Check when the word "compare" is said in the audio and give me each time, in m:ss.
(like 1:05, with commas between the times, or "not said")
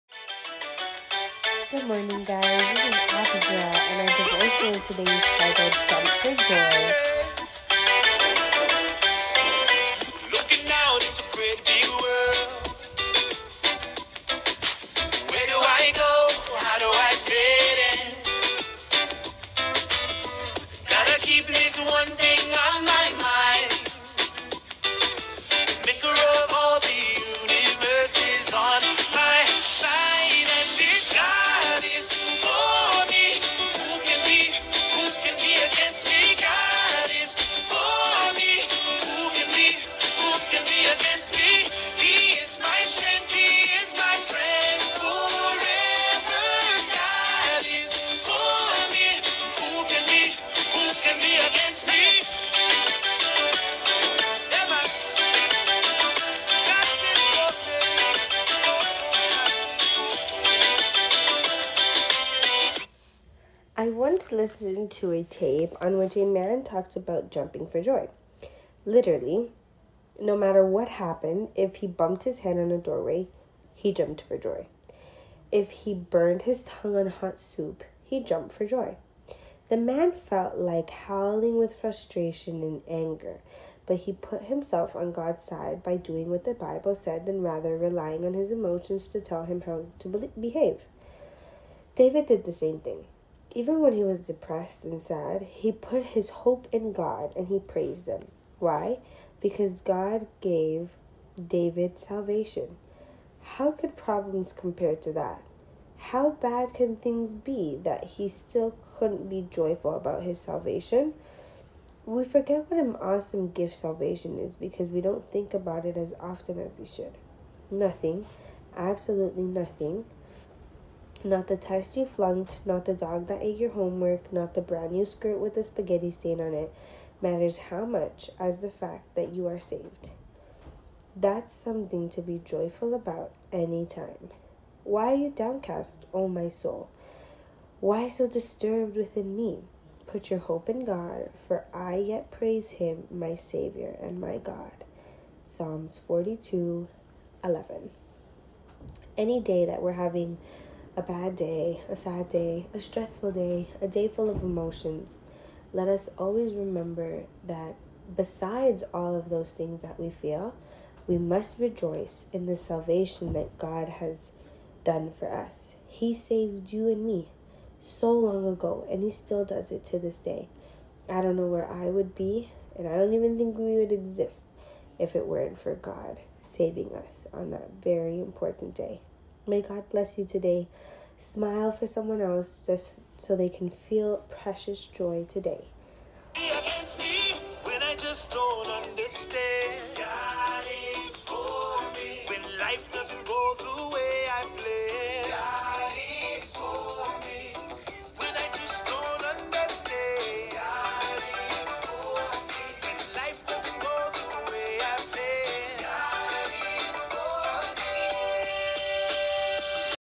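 1:44.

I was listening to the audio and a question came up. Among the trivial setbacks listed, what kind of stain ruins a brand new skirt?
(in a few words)
Spaghetti.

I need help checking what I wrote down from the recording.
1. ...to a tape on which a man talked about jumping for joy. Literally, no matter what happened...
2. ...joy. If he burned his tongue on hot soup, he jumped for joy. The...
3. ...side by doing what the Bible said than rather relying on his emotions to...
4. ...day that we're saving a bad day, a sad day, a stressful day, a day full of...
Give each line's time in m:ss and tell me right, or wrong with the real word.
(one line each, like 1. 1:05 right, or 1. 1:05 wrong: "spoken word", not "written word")
1. 1:04 right
2. 1:14 right
3. 1:25 right
4. 2:29 wrong: "having", not "saving".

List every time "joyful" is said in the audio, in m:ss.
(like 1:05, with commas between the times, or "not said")
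1:49, 2:12.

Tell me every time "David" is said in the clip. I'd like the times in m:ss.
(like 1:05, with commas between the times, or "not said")
1:31, 1:41.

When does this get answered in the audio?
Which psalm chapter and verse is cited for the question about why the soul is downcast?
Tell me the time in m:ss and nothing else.
2:25.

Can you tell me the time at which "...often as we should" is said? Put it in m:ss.
1:56.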